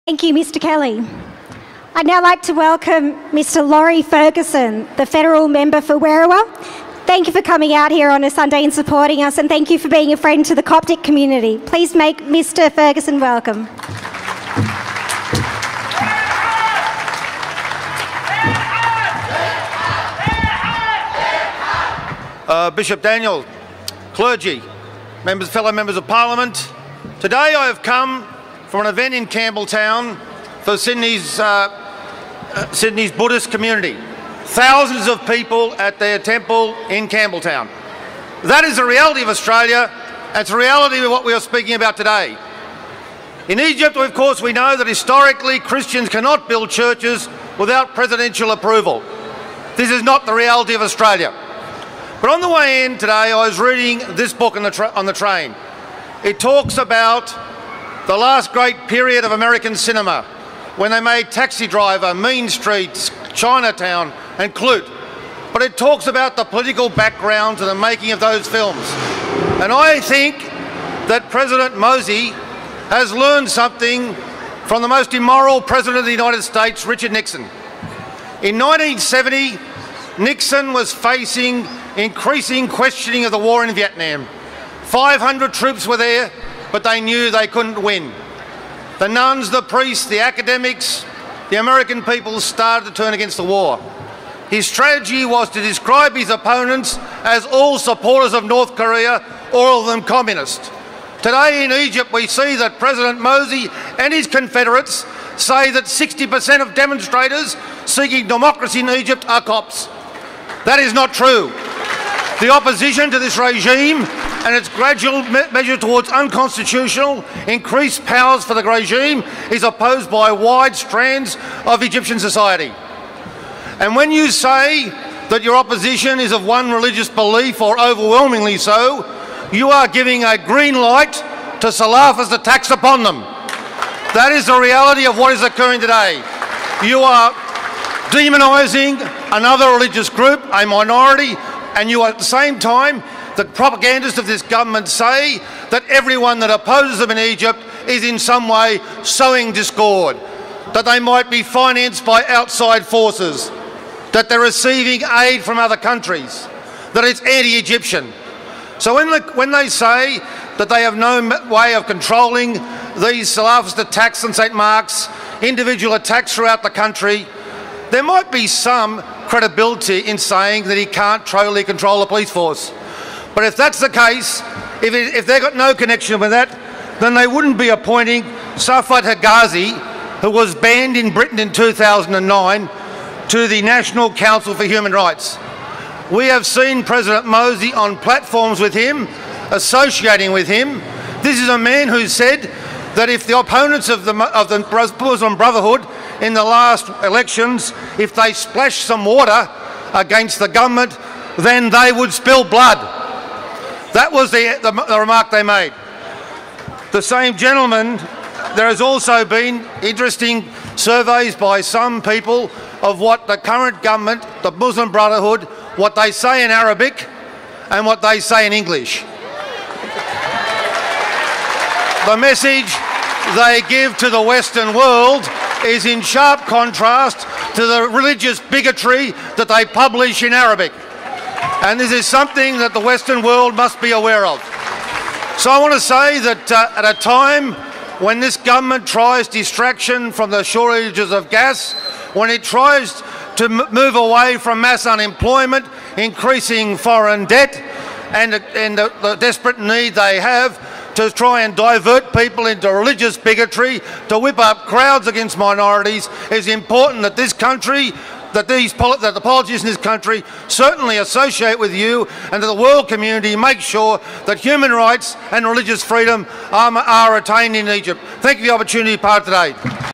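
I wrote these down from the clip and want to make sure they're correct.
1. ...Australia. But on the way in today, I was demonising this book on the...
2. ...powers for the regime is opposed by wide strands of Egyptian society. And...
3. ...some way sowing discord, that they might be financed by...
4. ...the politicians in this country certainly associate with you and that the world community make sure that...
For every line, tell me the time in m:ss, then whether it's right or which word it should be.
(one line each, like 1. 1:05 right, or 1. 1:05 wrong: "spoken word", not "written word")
1. 0:50 wrong: "reading", not "demonising"
2. 1:58 right
3. 2:28 right
4. 4:19 right.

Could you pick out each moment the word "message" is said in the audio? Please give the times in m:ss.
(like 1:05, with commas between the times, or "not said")
3:42.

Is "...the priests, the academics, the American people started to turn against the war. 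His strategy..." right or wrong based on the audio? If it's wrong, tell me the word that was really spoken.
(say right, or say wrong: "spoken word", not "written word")
right.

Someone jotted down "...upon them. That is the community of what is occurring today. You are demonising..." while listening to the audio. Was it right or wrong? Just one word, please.
wrong.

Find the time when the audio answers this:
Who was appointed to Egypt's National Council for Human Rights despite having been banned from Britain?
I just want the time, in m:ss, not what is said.
2:58.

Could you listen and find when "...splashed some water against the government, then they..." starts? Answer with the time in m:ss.
3:18.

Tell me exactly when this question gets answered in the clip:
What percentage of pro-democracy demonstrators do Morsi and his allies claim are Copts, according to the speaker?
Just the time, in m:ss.
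1:45.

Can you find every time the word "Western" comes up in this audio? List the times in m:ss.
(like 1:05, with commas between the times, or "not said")
3:44, 3:52.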